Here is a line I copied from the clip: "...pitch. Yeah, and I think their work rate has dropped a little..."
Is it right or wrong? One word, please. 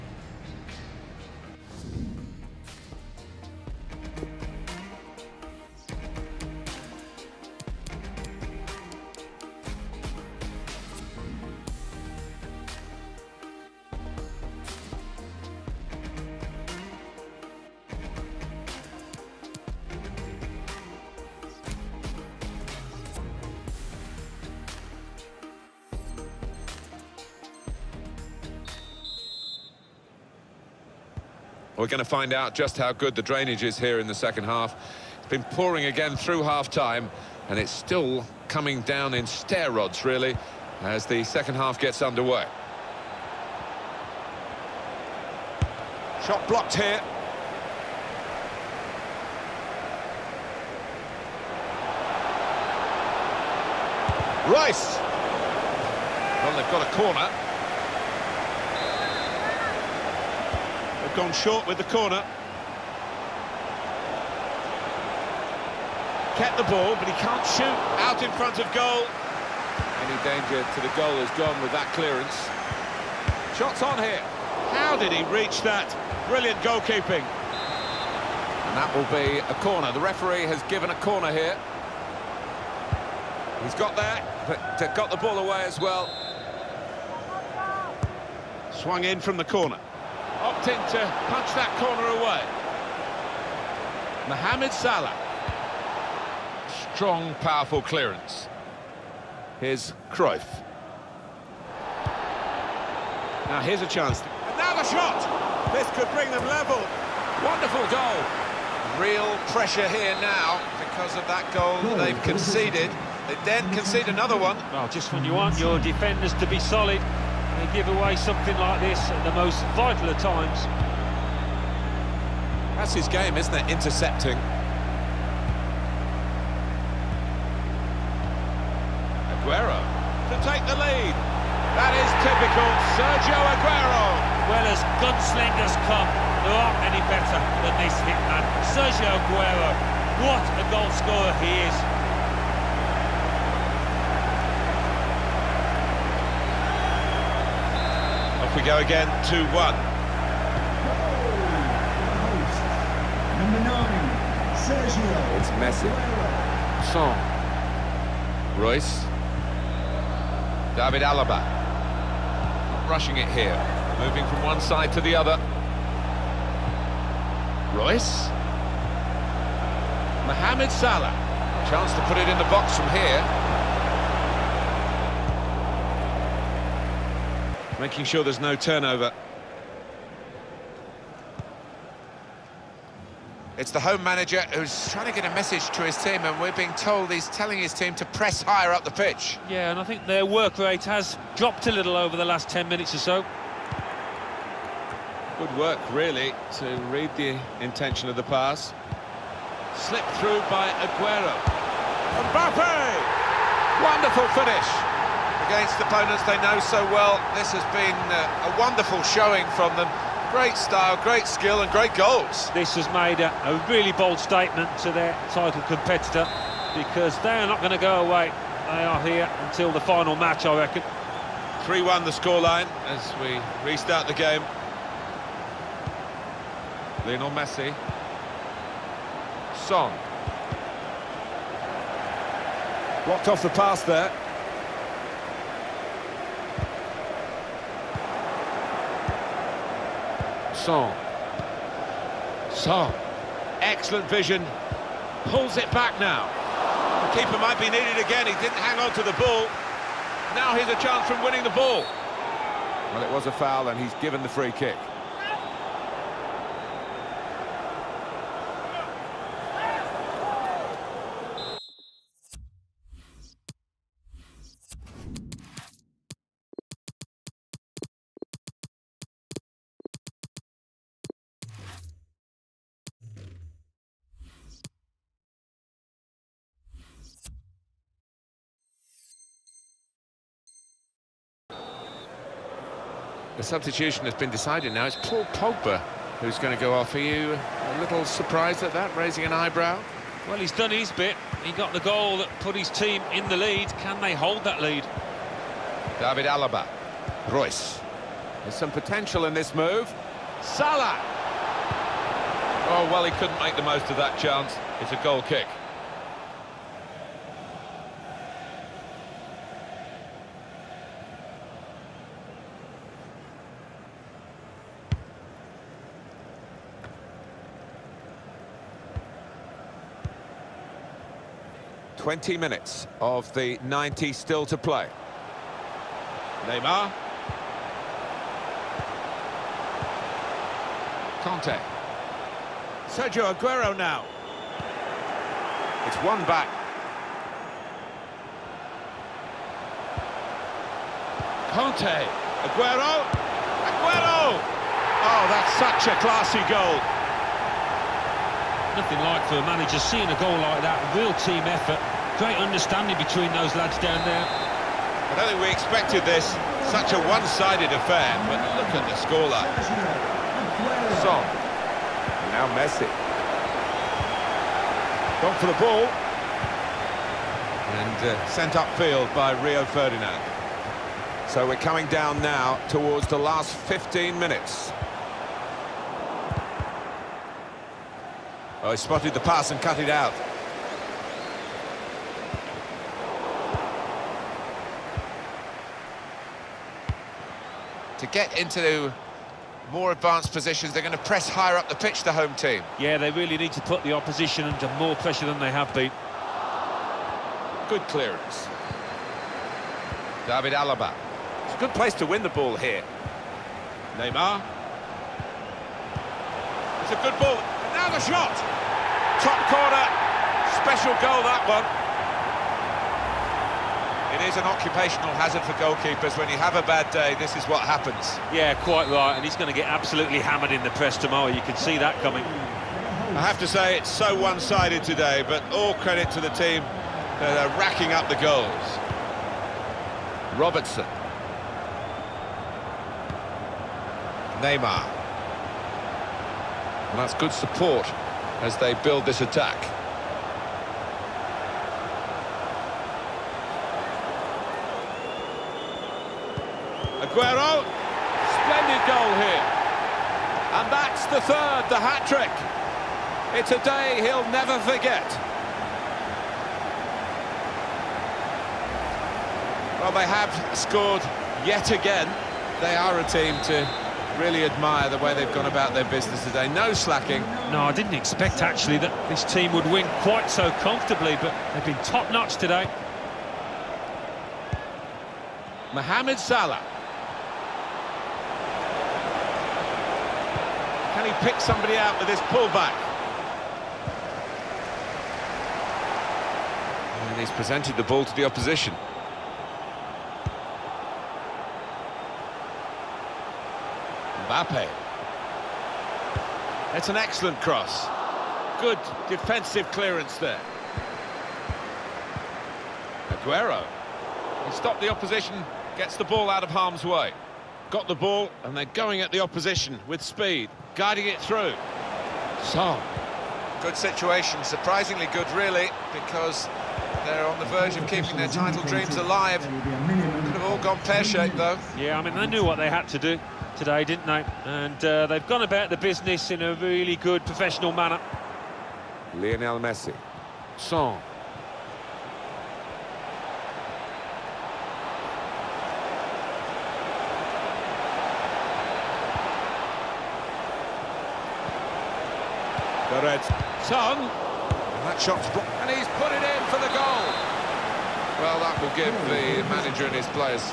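right.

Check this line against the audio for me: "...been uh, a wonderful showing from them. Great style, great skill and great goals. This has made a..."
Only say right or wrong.
right.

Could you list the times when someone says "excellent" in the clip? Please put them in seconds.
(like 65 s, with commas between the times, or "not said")
243 s, 496 s.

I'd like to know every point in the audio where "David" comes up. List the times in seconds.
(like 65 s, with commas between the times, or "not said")
160 s, 295 s, 400 s.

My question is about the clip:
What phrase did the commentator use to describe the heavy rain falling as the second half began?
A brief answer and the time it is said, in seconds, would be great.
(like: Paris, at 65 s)
Stair rods, at 39 s.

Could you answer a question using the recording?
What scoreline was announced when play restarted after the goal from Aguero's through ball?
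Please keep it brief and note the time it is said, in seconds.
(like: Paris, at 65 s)
3-1, at 221 s.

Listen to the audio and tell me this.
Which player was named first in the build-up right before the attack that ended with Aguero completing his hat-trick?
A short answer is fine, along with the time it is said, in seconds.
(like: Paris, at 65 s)
Robertson, at 430 s.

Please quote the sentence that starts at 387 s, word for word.
To get into more advanced positions, they're going to press higher up the pitch, the home team.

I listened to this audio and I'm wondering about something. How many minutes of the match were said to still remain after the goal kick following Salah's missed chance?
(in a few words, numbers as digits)
20.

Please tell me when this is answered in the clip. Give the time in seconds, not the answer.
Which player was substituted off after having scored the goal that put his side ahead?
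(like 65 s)
285 s.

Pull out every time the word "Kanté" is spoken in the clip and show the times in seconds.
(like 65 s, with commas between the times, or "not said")
331 s, 341 s.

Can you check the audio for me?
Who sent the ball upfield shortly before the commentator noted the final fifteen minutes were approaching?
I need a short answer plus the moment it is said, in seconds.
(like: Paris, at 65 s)
Rio Ferdinand, at 369 s.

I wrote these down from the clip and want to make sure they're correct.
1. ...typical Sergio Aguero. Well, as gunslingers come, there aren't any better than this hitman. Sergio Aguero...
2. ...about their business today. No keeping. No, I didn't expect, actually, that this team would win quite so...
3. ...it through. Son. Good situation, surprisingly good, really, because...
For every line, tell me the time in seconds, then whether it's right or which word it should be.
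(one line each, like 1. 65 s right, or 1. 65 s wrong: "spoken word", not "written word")
1. 132 s right
2. 465 s wrong: "slacking", not "keeping"
3. 511 s right.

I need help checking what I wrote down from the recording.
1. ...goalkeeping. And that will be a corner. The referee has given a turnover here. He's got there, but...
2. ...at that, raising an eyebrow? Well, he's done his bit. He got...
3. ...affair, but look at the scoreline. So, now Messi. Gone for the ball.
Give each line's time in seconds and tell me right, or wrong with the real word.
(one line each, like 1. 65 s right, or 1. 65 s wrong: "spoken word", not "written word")
1. 76 s wrong: "corner", not "turnover"
2. 288 s right
3. 357 s right.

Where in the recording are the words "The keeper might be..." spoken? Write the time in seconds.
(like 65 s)
247 s.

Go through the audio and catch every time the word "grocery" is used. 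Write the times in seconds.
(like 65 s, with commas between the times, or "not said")
not said.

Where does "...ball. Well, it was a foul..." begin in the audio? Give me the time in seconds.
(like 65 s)
251 s.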